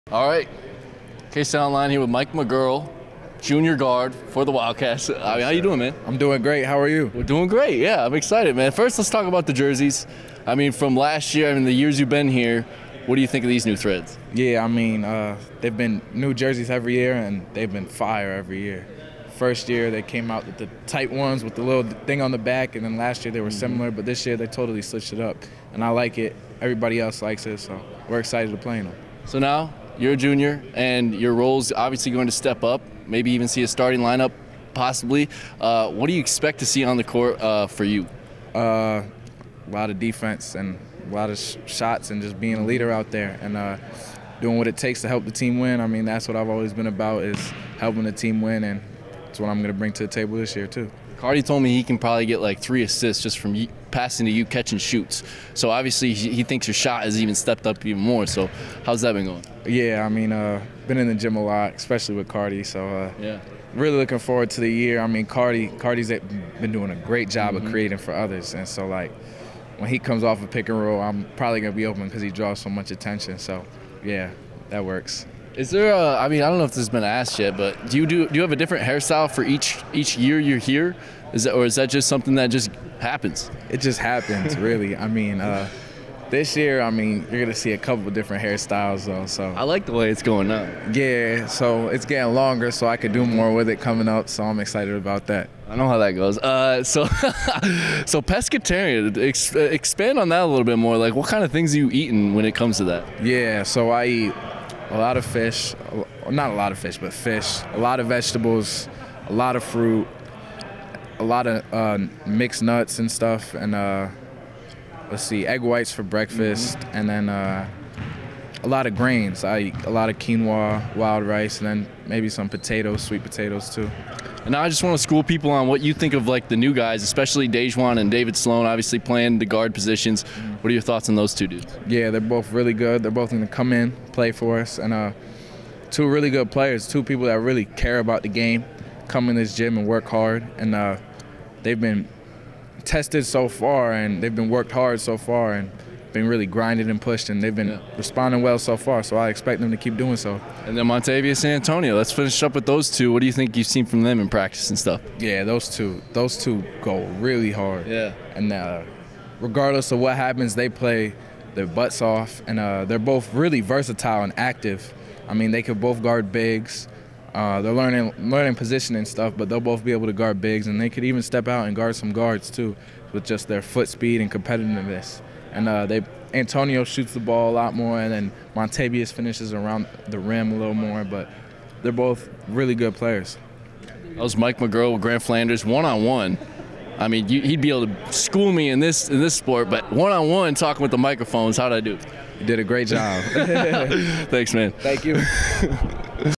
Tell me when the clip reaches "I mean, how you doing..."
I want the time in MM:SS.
00:05.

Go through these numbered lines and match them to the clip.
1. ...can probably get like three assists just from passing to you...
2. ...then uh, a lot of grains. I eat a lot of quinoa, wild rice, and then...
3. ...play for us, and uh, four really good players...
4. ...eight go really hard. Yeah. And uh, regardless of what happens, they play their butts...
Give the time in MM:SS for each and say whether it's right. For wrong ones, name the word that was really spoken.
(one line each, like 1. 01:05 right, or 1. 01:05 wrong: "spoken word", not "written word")
1. 00:51 right
2. 01:57 right
3. 02:14 wrong: "two", not "four"
4. 02:36 wrong: "two", not "eight".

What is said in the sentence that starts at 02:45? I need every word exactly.
I mean, they could both guard bigs.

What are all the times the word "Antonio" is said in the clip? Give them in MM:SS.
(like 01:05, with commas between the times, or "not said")
02:31, 02:56.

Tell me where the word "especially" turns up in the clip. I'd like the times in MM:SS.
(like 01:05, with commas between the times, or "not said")
01:01, 02:07.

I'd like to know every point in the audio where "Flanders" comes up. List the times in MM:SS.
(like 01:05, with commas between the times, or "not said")
03:05.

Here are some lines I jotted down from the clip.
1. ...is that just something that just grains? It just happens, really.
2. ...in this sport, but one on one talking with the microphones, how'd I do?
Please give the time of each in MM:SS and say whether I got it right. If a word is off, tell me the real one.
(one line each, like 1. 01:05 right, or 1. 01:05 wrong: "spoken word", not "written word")
1. 01:21 wrong: "happens", not "grains"
2. 03:09 right.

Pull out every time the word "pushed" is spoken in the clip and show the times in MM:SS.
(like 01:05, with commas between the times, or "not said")
02:27.